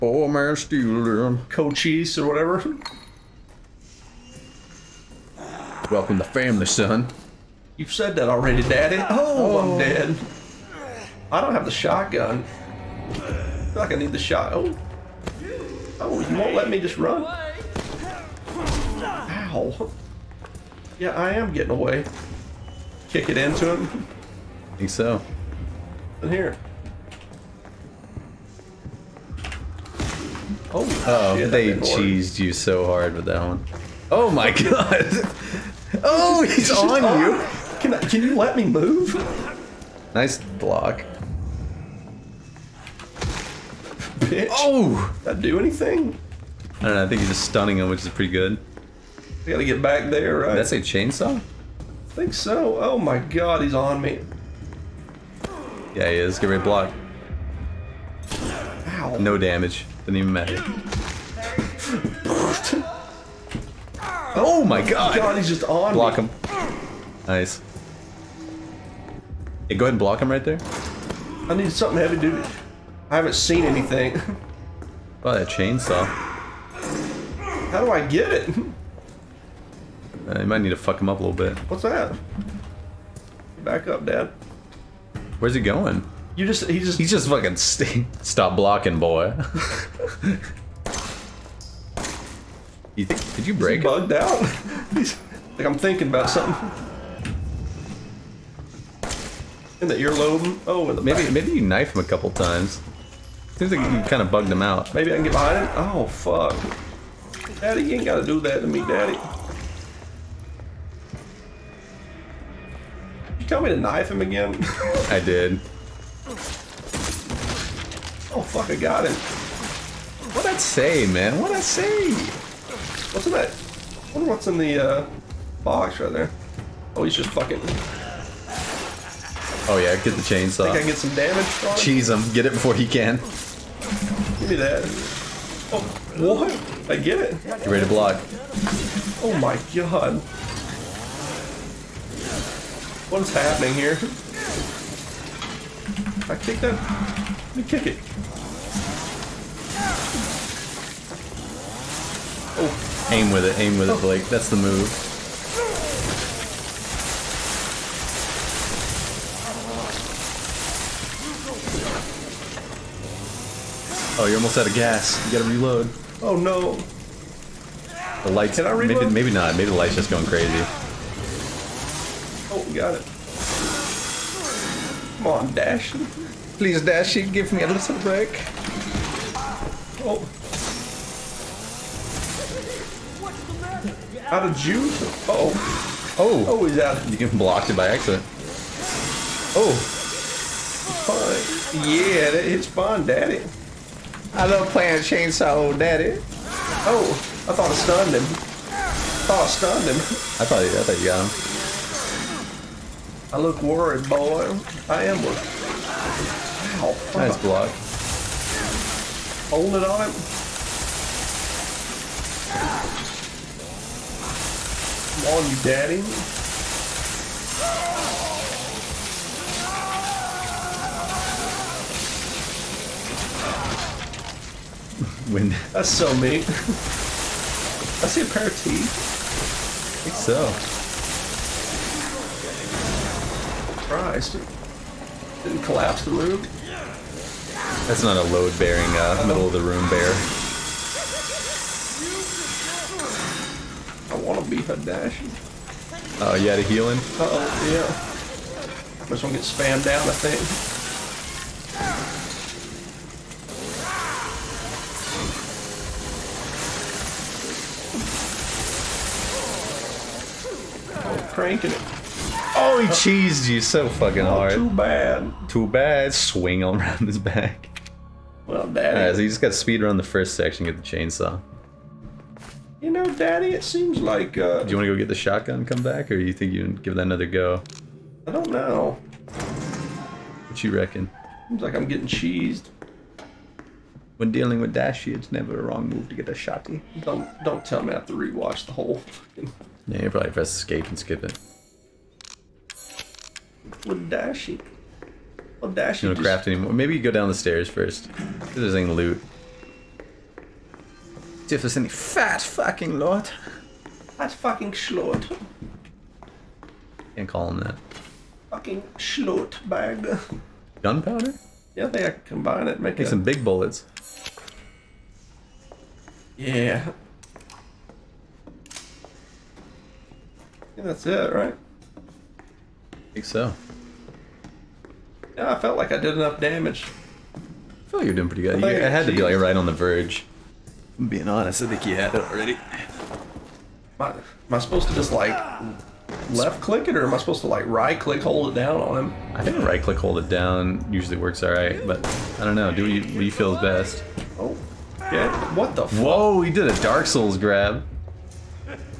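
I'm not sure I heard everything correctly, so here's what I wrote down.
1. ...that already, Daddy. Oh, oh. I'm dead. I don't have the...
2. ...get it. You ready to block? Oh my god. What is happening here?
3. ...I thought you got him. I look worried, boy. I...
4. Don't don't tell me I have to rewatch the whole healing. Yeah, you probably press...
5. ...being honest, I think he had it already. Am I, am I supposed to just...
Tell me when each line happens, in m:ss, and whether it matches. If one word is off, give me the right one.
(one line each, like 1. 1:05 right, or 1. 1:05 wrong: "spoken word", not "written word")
1. 0:08 right
2. 2:16 right
3. 3:20 right
4. 4:47 wrong: "fucking", not "healing"
5. 5:31 right.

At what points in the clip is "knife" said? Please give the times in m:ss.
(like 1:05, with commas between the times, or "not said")
1:41, 1:53.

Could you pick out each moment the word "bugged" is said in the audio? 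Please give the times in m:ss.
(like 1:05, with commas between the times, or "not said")
1:33, 1:44.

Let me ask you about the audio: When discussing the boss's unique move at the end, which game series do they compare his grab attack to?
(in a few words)
Dark Souls.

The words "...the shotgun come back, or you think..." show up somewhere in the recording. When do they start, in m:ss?
4:35.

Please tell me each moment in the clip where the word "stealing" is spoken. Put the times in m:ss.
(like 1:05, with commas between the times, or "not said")
0:00.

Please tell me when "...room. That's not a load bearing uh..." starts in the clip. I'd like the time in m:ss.
3:56.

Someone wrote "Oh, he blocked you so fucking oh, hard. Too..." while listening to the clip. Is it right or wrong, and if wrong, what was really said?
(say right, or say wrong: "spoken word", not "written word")
wrong: "cheesed", not "blocked".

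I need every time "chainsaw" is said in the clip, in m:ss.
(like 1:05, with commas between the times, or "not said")
0:50, 1:15, 2:10, 3:14, 4:30.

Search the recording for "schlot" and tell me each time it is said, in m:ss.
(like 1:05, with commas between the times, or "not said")
5:04, 5:08.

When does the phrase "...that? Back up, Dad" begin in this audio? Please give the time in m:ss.
1:21.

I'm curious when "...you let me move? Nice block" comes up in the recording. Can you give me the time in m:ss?
0:38.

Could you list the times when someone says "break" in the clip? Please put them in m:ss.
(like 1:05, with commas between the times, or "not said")
1:33, 2:57.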